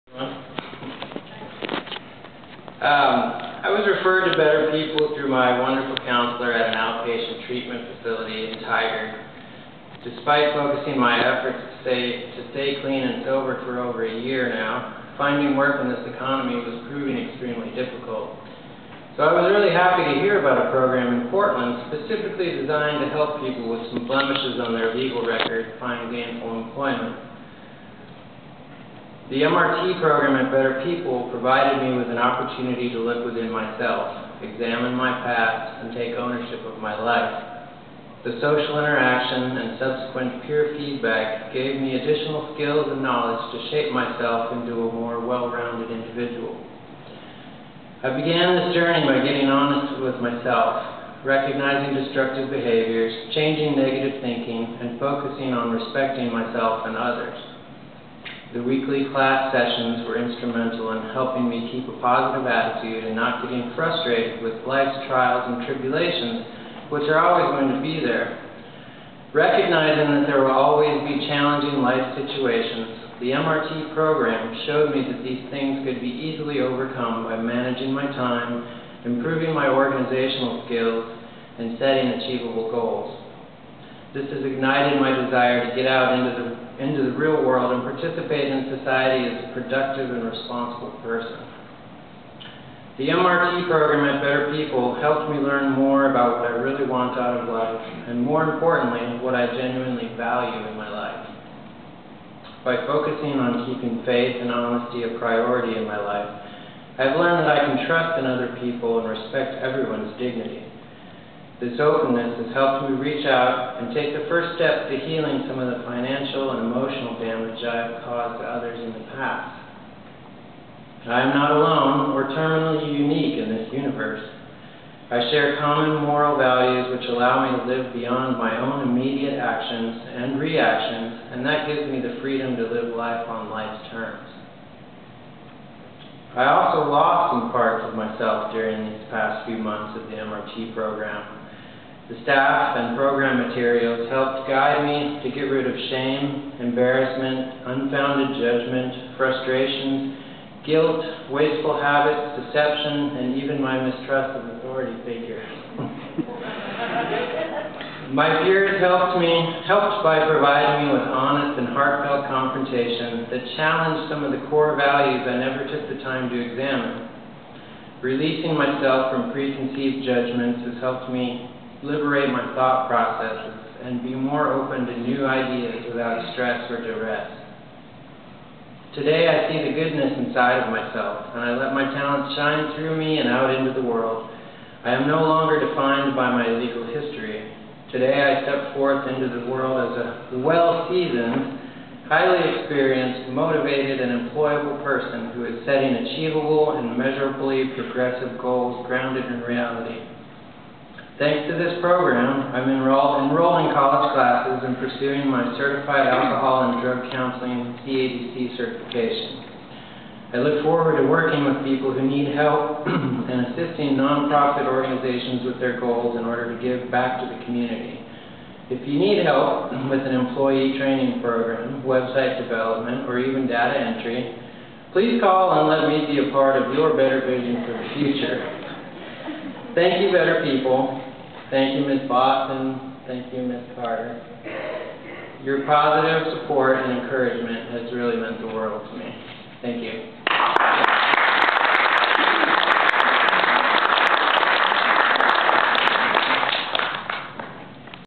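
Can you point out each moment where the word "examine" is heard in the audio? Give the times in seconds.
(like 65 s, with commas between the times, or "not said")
34 s, 166 s.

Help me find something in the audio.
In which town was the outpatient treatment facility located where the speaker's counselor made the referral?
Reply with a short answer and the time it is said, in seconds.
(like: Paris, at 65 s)
Tigard, at 8 s.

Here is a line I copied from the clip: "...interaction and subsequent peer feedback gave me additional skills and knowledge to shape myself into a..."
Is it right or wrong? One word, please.
right.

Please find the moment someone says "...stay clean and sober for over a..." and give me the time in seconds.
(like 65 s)
12 s.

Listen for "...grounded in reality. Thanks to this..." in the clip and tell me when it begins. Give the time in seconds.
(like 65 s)
198 s.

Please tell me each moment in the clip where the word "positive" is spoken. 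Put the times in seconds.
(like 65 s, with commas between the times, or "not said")
62 s, 235 s.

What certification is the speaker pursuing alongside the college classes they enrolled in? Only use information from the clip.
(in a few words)
CADC.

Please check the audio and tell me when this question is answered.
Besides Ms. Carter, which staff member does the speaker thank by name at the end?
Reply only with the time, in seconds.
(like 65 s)
231 s.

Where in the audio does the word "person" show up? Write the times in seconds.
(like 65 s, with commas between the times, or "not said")
90 s, 194 s.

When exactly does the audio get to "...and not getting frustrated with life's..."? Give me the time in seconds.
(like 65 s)
63 s.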